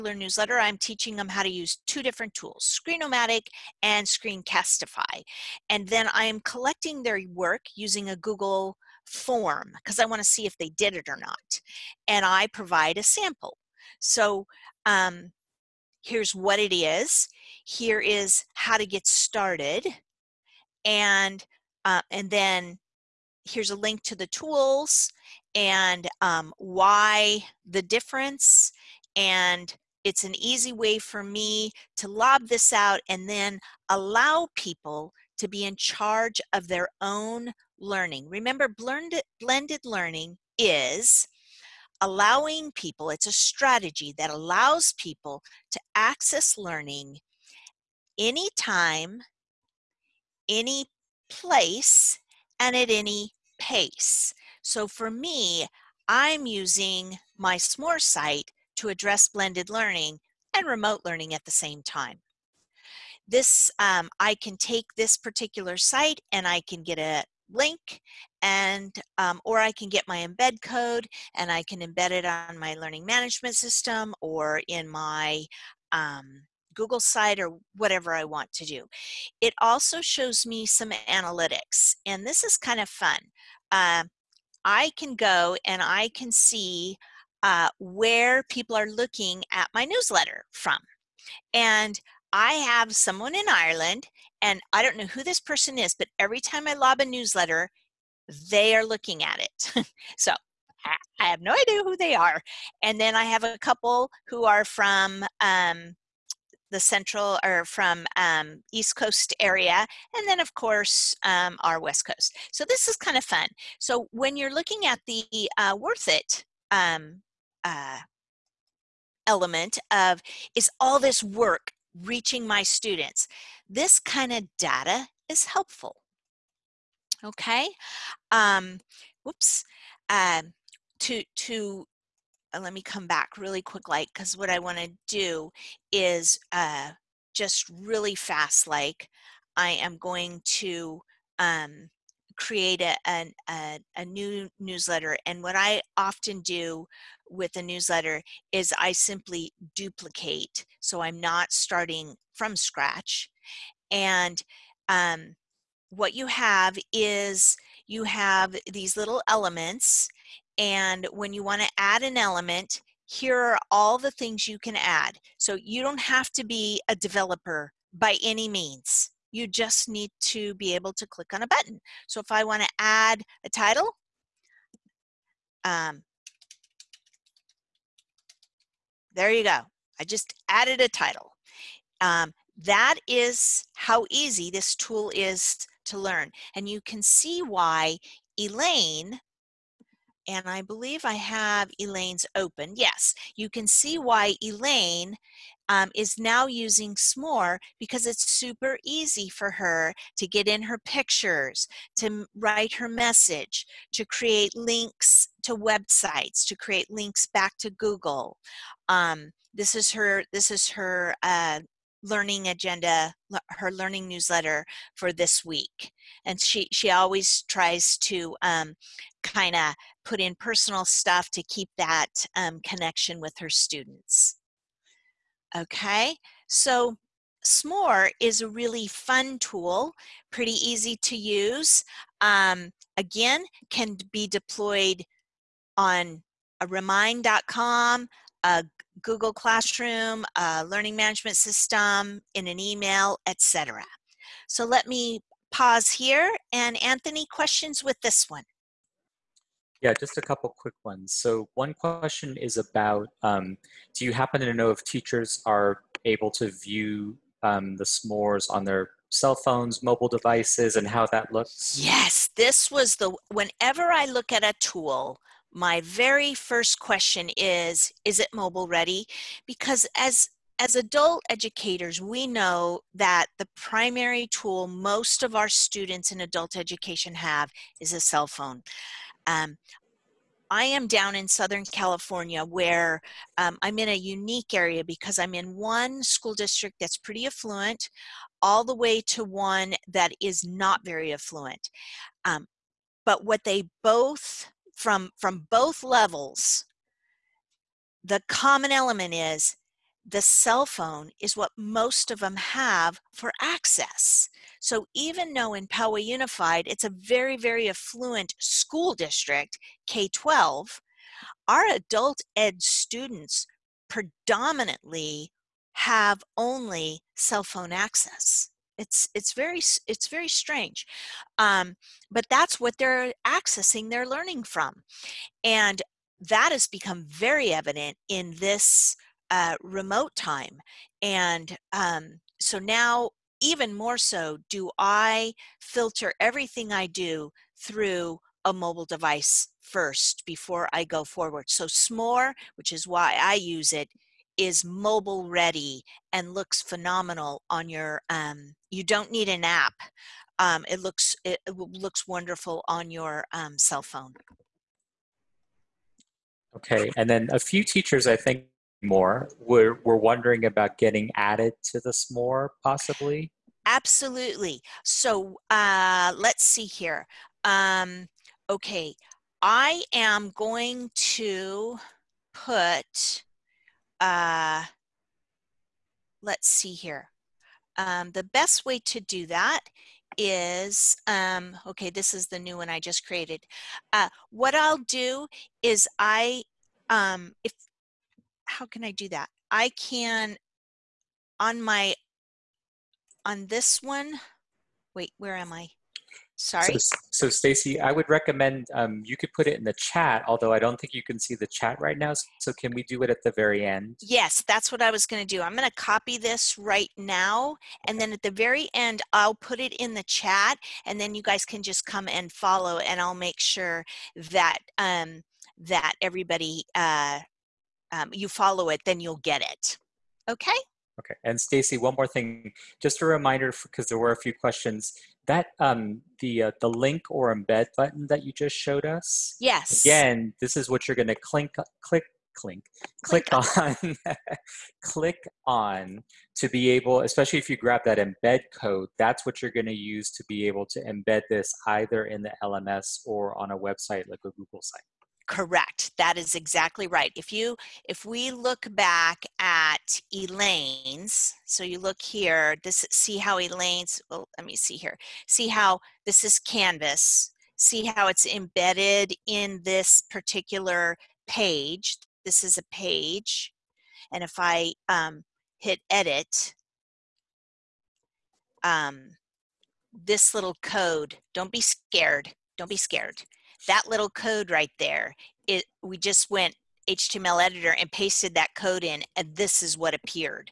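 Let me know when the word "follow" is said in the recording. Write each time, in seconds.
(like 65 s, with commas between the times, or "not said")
412 s, 418 s.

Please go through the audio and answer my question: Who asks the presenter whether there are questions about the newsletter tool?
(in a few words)
Anthony.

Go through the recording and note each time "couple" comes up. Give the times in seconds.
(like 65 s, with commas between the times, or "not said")
103 s, 250 s.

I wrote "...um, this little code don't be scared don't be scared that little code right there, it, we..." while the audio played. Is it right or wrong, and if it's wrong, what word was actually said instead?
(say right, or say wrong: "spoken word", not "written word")
right.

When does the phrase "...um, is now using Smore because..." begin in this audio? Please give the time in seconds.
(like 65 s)
195 s.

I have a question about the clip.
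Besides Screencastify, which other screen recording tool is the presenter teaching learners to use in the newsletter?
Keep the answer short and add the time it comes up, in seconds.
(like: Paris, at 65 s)
Screenomatic, at 2 s.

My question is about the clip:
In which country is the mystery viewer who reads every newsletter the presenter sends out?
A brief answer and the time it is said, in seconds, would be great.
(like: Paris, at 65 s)
Ireland, at 93 s.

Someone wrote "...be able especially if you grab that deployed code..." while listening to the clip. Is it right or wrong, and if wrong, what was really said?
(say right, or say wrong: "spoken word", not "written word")
wrong: "embed", not "deployed".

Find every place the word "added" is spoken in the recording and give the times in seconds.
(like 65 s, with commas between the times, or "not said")
180 s, 361 s.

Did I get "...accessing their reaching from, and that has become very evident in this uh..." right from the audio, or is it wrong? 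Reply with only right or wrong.
wrong.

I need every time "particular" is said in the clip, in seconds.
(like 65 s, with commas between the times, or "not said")
65 s, 460 s.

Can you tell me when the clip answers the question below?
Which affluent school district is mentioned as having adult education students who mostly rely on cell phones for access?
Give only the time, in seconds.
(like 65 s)
305 s.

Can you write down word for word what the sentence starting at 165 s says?
So you don't have to be a developer by any means.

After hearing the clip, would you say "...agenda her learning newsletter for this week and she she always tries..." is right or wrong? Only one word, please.
right.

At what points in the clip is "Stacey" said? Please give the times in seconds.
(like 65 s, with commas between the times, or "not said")
397 s, 421 s.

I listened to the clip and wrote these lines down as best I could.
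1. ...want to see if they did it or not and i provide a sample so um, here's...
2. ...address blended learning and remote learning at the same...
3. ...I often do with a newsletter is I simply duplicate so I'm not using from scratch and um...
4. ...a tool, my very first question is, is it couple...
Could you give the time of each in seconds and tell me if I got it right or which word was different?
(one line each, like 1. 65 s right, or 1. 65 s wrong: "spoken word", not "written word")
1. 10 s right
2. 58 s right
3. 145 s wrong: "starting", not "using"
4. 264 s wrong: "mobile", not "couple".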